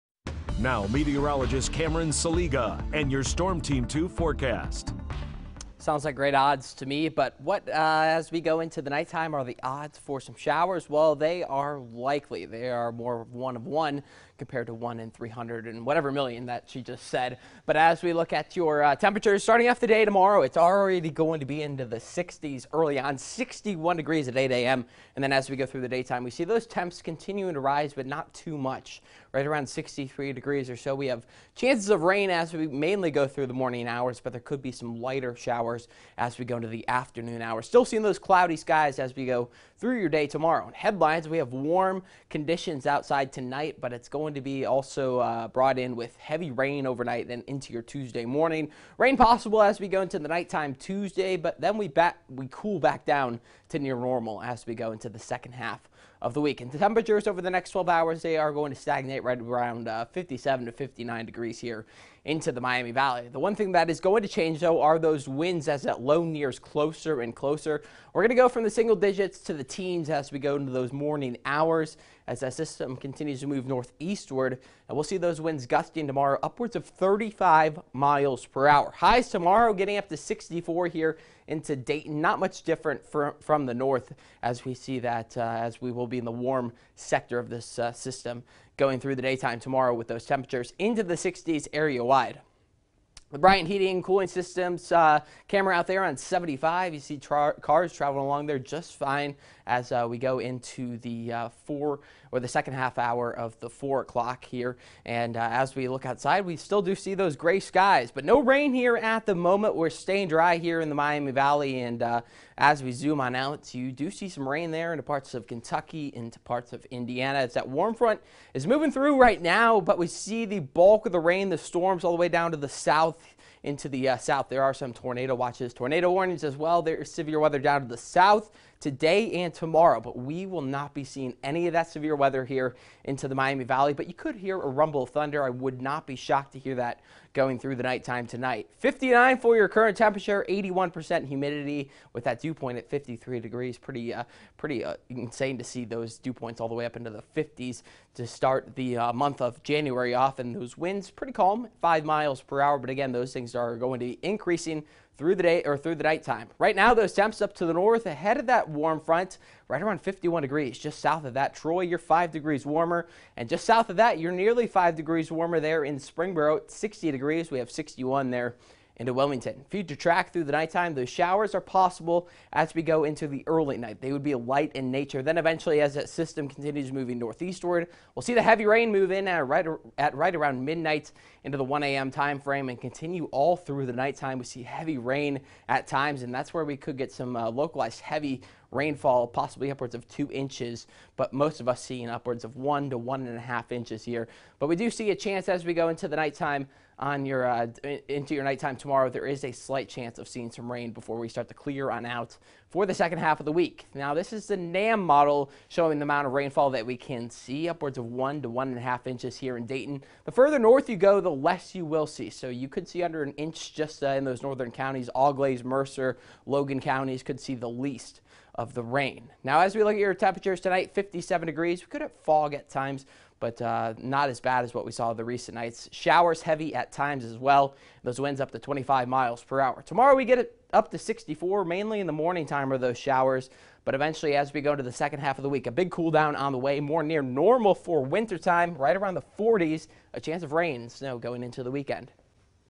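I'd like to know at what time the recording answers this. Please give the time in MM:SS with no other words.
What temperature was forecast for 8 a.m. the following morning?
00:23.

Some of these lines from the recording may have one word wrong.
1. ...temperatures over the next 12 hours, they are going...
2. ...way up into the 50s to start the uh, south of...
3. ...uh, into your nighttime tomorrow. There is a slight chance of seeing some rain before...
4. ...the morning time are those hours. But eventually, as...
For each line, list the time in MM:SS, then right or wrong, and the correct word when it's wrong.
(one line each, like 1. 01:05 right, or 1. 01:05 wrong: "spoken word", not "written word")
1. 00:56 right
2. 02:26 wrong: "month", not "south"
3. 03:17 right
4. 03:52 wrong: "showers", not "hours".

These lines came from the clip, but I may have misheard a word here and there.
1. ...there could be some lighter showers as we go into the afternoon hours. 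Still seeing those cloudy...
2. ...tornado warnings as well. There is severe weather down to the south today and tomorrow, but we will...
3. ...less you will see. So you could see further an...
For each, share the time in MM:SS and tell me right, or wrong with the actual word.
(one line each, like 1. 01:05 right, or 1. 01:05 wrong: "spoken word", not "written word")
1. 00:34 right
2. 02:05 right
3. 03:31 wrong: "under", not "further".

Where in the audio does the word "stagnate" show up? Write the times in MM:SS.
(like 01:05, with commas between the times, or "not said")
00:58.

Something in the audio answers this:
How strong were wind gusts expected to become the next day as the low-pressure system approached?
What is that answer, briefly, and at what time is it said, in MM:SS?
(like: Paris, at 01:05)
35 miles per hour, at 01:16.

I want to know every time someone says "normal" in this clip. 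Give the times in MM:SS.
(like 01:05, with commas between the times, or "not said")
00:53, 03:57.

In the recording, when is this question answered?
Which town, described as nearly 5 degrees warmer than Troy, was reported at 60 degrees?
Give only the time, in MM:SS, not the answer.
02:45.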